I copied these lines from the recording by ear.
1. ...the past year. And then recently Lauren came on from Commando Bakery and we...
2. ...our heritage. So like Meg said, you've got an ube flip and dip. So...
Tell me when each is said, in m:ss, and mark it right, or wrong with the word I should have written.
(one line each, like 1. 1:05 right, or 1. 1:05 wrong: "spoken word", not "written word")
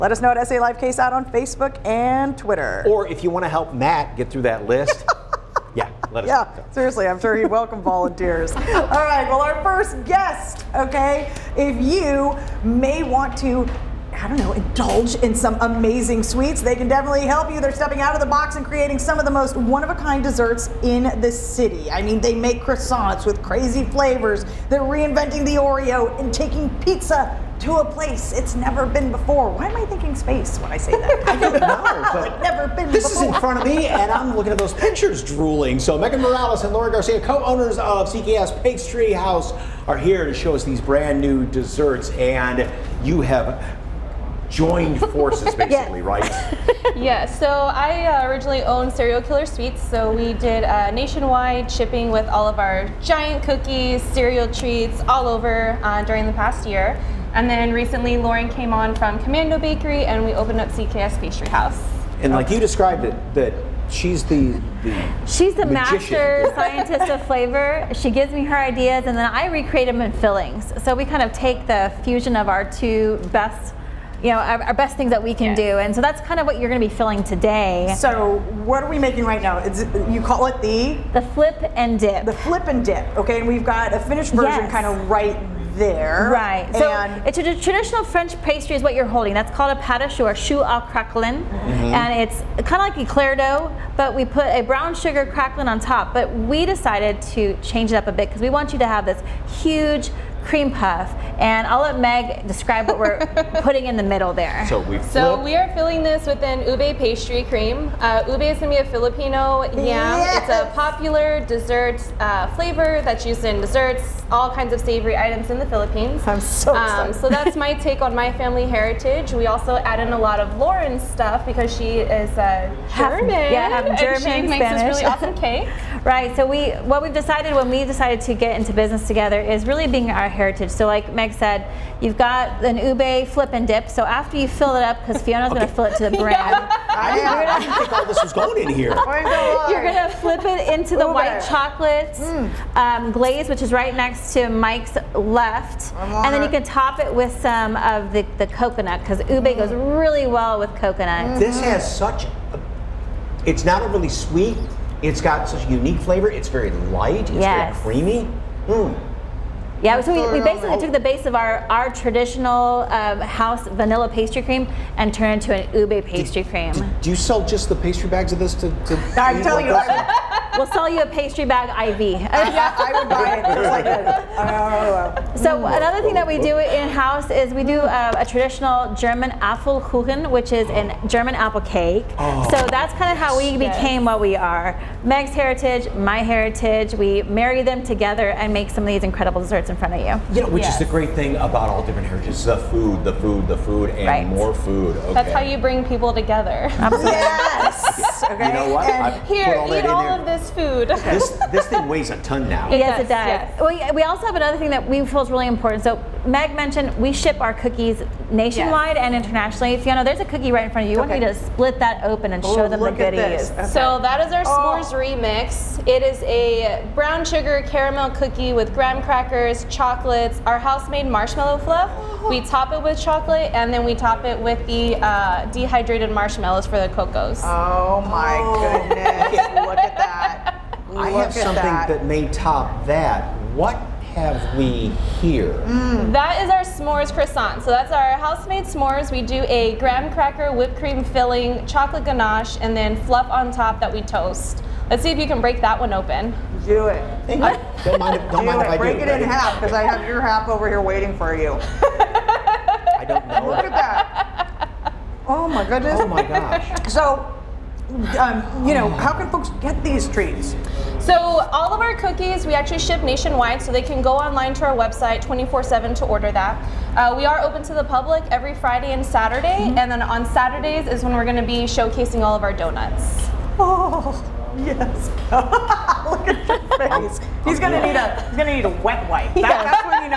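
1. 0:56 right
2. 2:10 right.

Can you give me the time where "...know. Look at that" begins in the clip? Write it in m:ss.
4:13.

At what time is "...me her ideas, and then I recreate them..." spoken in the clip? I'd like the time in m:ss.
1:08.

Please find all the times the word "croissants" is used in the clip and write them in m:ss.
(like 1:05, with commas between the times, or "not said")
0:22, 3:57.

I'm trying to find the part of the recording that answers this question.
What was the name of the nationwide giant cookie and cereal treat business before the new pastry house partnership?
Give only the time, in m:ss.
0:48.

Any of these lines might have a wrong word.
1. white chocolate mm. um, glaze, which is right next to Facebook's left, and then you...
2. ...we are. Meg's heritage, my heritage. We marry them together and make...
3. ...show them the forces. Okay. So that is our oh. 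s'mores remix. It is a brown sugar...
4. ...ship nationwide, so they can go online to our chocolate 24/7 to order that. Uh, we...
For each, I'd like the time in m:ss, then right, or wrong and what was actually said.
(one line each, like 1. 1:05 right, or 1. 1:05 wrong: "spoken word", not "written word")
1. 2:21 wrong: "Mike", not "Facebook"
2. 3:04 right
3. 3:32 wrong: "goodies", not "forces"
4. 4:22 wrong: "website", not "chocolate".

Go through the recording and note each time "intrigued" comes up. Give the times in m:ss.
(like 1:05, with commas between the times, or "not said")
not said.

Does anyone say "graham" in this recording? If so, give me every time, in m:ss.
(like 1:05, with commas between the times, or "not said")
3:38, 3:59.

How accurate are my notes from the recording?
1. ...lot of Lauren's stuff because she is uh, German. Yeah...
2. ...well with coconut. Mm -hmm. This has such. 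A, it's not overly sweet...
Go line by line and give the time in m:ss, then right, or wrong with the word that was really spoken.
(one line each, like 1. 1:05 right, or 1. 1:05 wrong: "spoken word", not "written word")
1. 2:00 right
2. 2:30 right.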